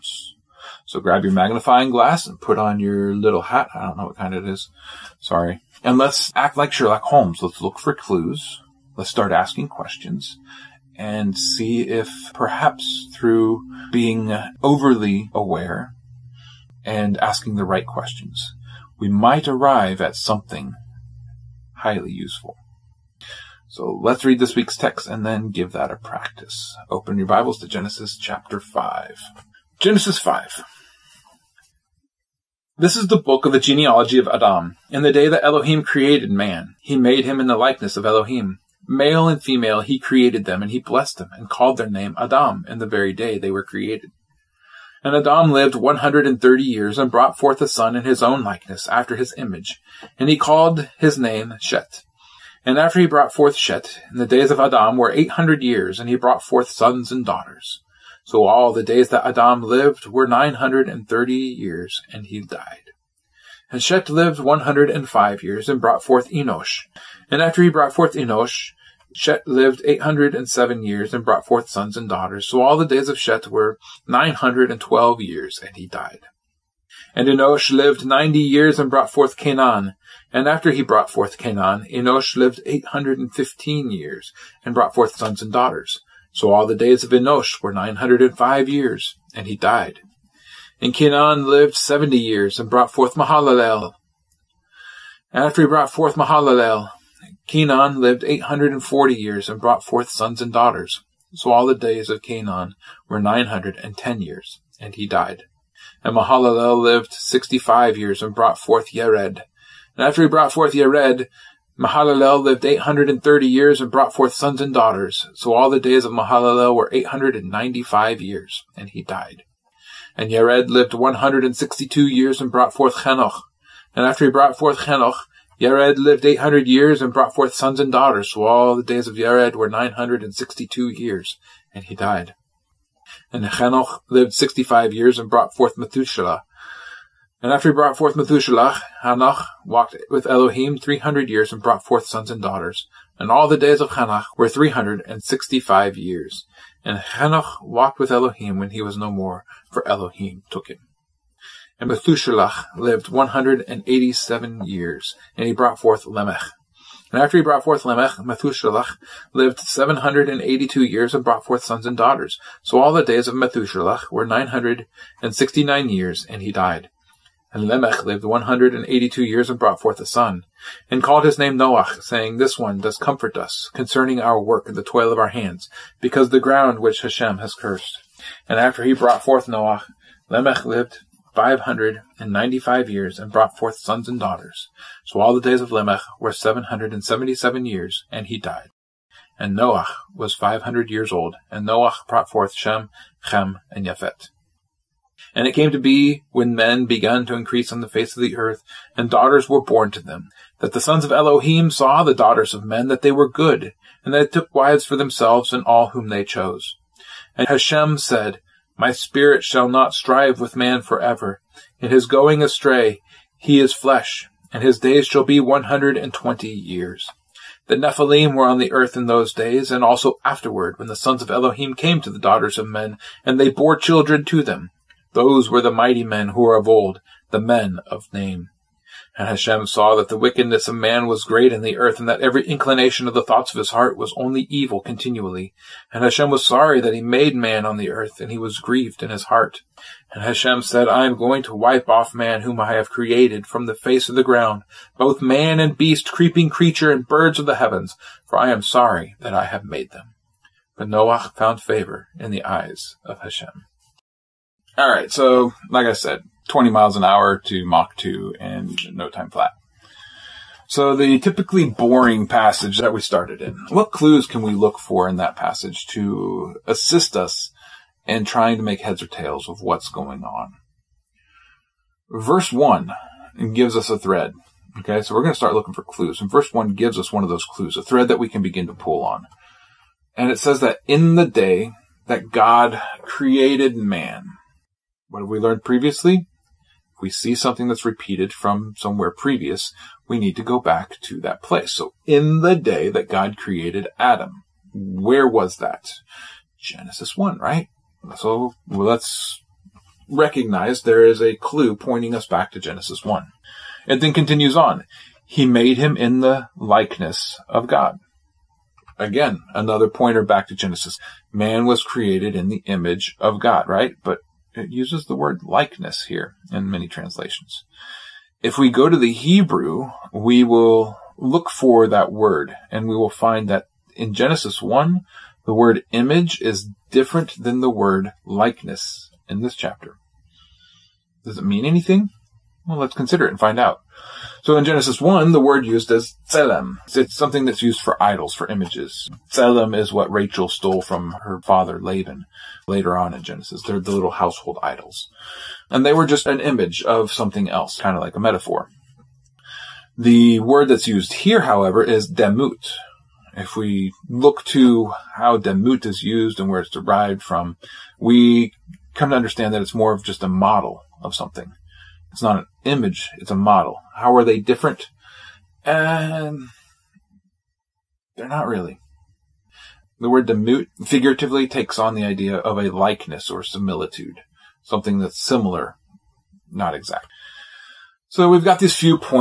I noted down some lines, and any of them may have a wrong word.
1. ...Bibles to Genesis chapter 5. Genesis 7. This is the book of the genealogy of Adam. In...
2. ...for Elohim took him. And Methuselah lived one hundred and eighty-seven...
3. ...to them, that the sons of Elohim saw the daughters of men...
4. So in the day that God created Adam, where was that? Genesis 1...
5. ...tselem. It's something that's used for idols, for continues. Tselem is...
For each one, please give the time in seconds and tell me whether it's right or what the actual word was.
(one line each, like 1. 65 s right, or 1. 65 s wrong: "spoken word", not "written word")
1. 27 s wrong: "5", not "7"
2. 149 s right
3. 199 s right
4. 291 s right
5. 336 s wrong: "images", not "continues".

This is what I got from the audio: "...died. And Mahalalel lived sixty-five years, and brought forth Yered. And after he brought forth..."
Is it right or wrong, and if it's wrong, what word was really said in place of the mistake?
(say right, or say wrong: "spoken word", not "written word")
right.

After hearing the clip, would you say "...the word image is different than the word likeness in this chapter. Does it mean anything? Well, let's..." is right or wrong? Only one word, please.
right.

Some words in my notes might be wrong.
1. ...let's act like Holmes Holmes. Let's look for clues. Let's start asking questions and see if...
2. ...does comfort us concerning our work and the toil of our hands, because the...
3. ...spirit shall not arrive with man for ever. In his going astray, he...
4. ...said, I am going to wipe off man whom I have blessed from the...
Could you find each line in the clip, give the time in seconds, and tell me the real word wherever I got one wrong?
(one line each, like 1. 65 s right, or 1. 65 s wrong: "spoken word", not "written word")
1. 5 s wrong: "Sherlock", not "Holmes"
2. 172 s right
3. 208 s wrong: "strive", not "arrive"
4. 240 s wrong: "created", not "blessed".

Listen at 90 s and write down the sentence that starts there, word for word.
And Kenan lived seventy years, and brought forth Mahalalel.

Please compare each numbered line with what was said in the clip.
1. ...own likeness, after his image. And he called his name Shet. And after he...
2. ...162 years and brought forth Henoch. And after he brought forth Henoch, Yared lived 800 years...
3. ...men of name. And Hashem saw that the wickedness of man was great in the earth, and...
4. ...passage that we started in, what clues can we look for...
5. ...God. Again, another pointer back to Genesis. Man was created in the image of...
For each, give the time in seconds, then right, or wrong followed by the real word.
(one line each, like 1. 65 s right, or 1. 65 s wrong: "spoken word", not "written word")
1. 48 s right
2. 120 s right
3. 227 s right
4. 262 s right
5. 307 s right.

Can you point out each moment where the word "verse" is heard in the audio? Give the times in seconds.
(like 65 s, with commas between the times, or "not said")
272 s, 276 s.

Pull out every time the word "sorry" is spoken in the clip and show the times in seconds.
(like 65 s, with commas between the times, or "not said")
5 s, 236 s, 248 s.